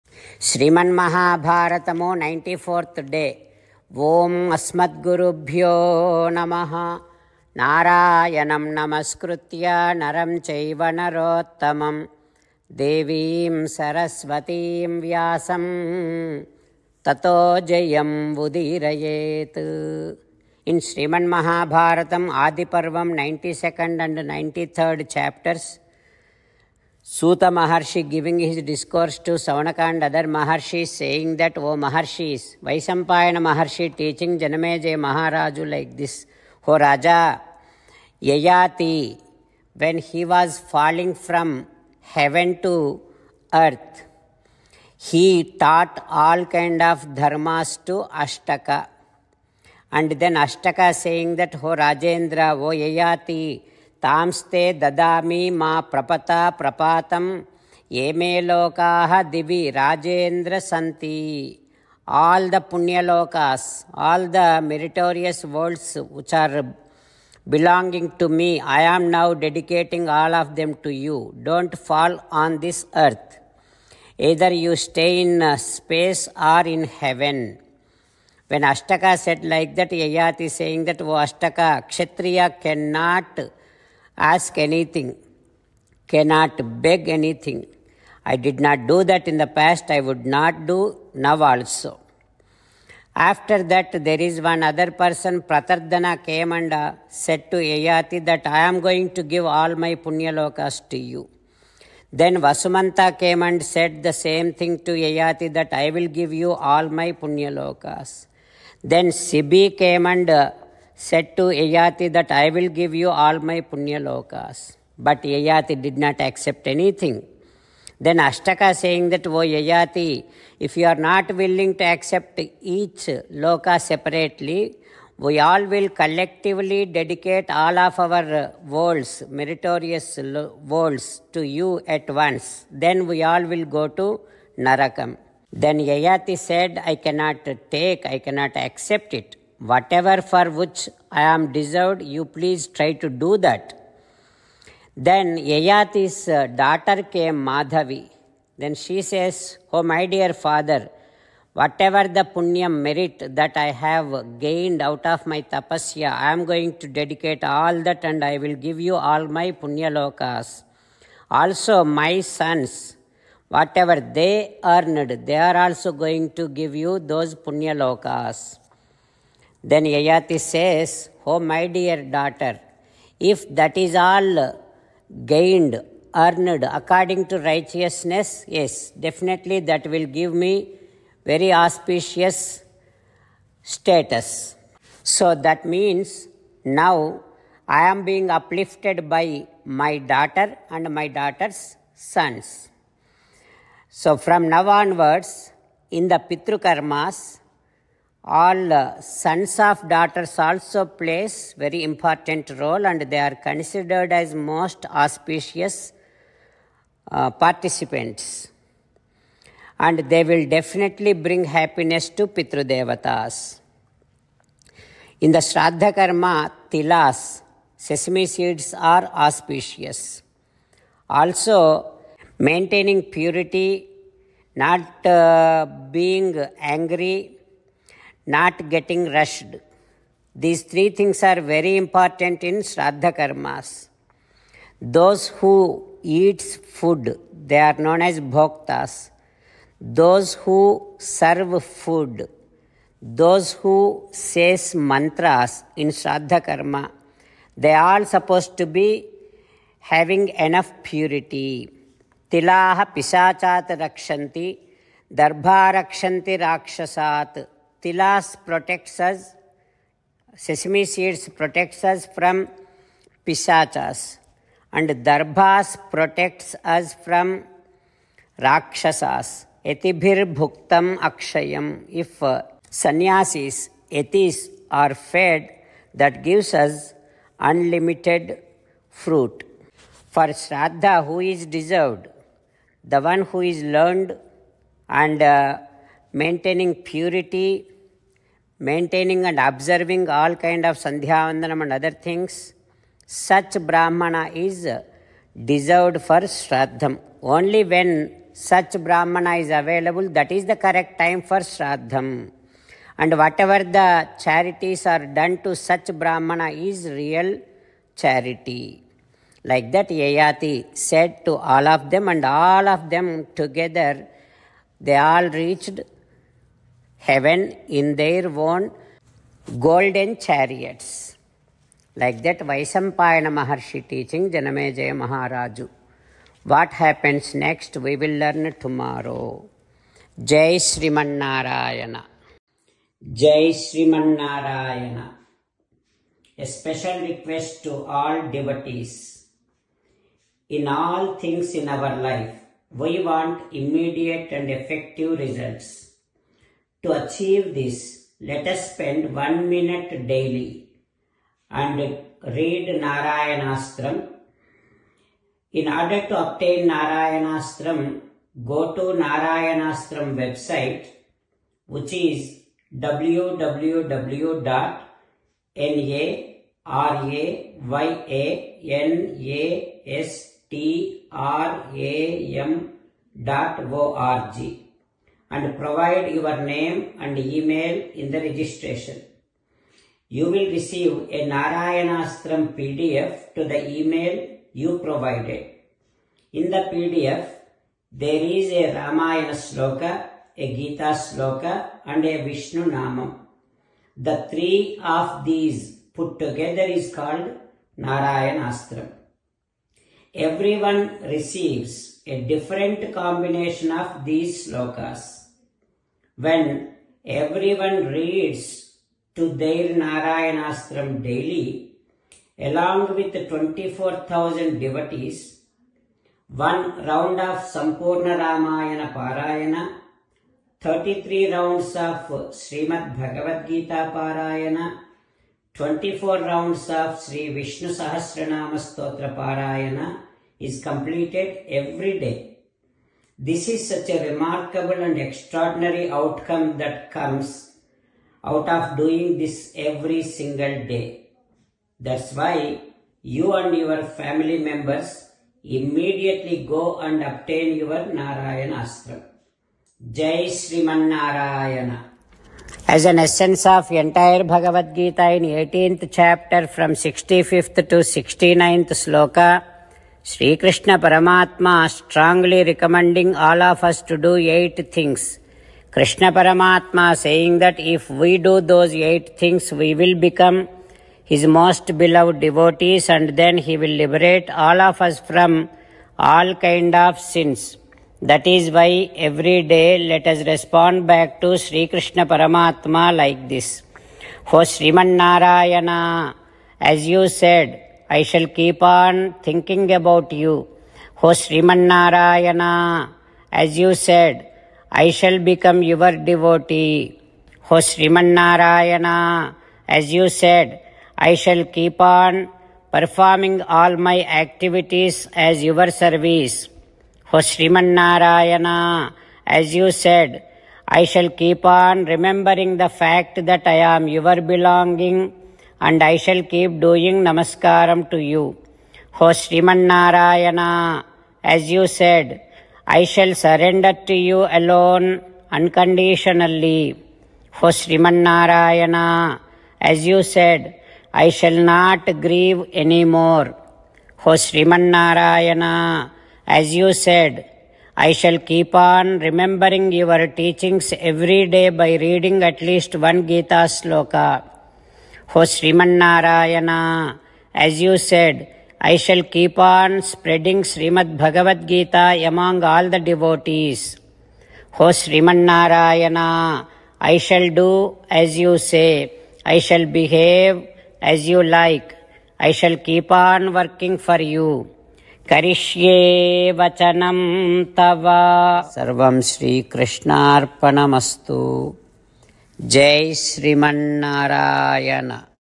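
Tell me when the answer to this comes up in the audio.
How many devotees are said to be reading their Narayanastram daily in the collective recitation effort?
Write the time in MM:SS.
06:53.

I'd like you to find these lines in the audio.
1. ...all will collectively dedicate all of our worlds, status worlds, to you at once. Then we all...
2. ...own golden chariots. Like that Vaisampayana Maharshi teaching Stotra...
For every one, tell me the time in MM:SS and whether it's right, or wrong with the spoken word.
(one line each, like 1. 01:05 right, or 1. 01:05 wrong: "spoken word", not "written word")
1. 02:05 wrong: "meritorious", not "status"
2. 05:18 wrong: "Janamejaya", not "Stotra".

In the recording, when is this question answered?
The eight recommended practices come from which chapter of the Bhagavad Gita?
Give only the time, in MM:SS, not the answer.
07:35.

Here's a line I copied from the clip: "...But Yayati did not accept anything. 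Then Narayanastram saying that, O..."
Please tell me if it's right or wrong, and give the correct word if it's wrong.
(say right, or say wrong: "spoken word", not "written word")
wrong: "Ashtaka", not "Narayanastram".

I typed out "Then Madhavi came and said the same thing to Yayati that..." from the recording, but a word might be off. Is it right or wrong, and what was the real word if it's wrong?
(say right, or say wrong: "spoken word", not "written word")
wrong: "Vasumanta", not "Madhavi".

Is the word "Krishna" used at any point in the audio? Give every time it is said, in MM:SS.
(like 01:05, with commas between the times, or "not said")
07:40, 07:45, 08:01.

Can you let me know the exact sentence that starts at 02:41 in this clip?
Also, my sons, whatever they earned, they are also going to give you those punyalokas.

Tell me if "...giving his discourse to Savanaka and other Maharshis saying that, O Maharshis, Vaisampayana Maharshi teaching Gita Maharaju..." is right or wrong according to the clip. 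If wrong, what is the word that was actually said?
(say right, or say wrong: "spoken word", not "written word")
wrong: "Janameja", not "Gita".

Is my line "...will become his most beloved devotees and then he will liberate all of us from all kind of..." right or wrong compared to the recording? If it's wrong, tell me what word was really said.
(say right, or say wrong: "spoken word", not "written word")
right.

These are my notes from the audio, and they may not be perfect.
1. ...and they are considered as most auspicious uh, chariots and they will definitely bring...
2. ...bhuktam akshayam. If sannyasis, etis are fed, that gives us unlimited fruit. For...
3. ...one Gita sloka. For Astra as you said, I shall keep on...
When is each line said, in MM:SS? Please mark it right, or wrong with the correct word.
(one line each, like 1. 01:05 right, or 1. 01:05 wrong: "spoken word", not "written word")
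1. 03:22 wrong: "participants", not "chariots"
2. 04:30 right
3. 09:02 wrong: "Sriman", not "Astra".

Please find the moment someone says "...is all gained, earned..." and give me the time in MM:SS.
02:53.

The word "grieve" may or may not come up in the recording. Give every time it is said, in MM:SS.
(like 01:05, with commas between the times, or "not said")
08:52.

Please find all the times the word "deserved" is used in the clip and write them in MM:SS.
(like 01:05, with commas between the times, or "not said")
02:21, 04:41, 04:55.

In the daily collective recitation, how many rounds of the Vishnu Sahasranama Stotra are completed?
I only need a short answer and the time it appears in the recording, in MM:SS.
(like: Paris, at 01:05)
24, at 07:05.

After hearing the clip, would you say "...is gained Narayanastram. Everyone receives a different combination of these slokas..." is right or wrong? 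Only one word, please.
wrong.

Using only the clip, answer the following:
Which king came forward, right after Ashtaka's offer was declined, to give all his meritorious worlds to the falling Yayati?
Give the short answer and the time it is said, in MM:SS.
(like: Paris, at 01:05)
Pratardhana, at 01:35.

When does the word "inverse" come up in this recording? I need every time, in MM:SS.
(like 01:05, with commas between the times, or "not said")
not said.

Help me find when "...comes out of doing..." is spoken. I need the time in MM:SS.
07:16.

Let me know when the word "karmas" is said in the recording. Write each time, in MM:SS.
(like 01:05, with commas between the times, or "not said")
03:16, 03:35, 03:53, 04:06.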